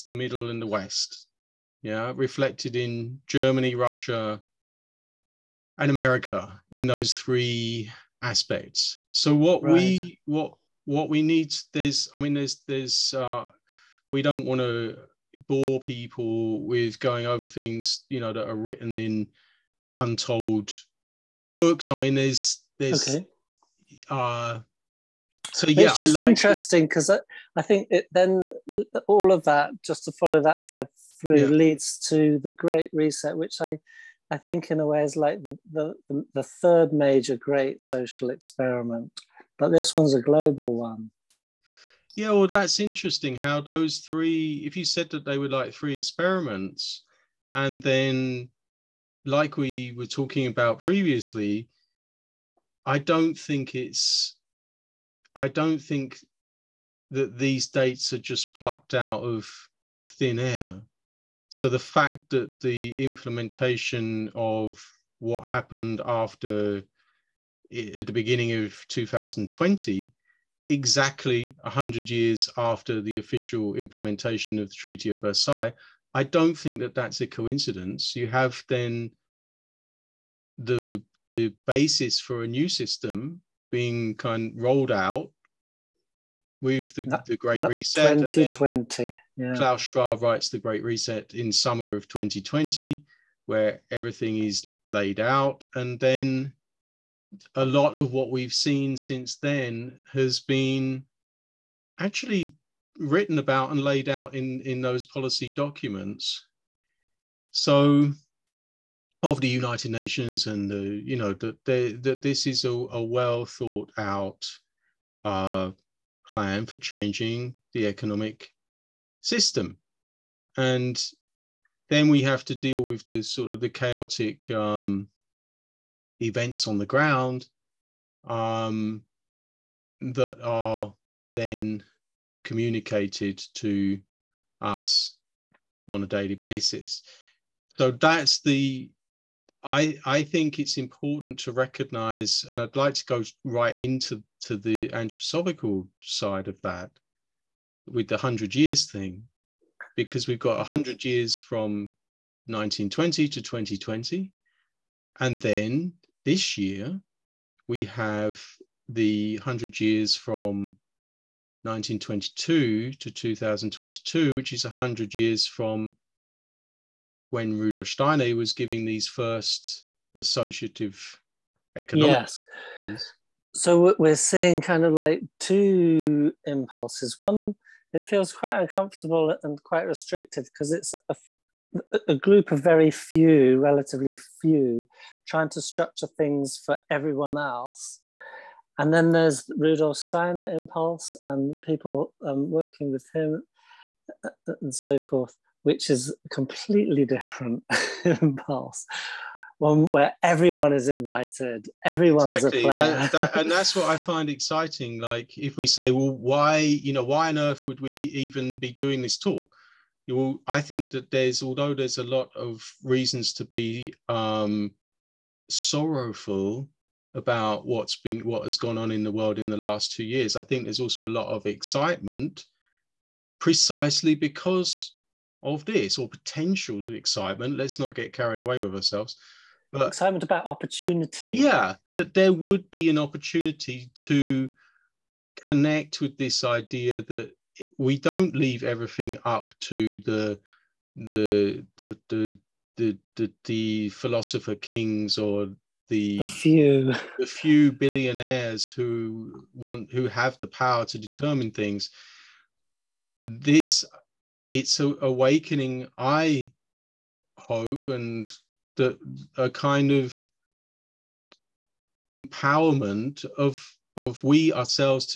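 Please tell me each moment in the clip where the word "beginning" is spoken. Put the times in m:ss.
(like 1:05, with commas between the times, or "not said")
1:08.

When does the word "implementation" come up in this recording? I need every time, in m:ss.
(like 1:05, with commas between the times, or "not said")
1:03, 1:13.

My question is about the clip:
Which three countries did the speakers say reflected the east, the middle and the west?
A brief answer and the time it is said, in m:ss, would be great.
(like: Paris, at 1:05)
Germany, Russia, and America, at 0:03.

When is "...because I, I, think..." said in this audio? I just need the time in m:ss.
0:26.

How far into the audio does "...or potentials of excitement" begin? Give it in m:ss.
3:45.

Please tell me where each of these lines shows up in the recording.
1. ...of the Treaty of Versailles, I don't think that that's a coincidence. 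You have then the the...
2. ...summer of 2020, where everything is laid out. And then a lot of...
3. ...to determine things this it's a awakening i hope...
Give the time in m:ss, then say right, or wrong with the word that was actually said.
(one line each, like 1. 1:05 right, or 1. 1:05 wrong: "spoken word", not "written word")
1. 1:14 right
2. 1:31 right
3. 4:10 right.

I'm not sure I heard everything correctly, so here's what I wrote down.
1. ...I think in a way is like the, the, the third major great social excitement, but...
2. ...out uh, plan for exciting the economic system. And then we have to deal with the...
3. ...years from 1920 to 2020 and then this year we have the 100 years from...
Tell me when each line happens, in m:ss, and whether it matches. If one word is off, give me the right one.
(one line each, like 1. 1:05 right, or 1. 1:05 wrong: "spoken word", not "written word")
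1. 0:34 wrong: "experiment", not "excitement"
2. 1:53 wrong: "changing", not "exciting"
3. 2:31 right.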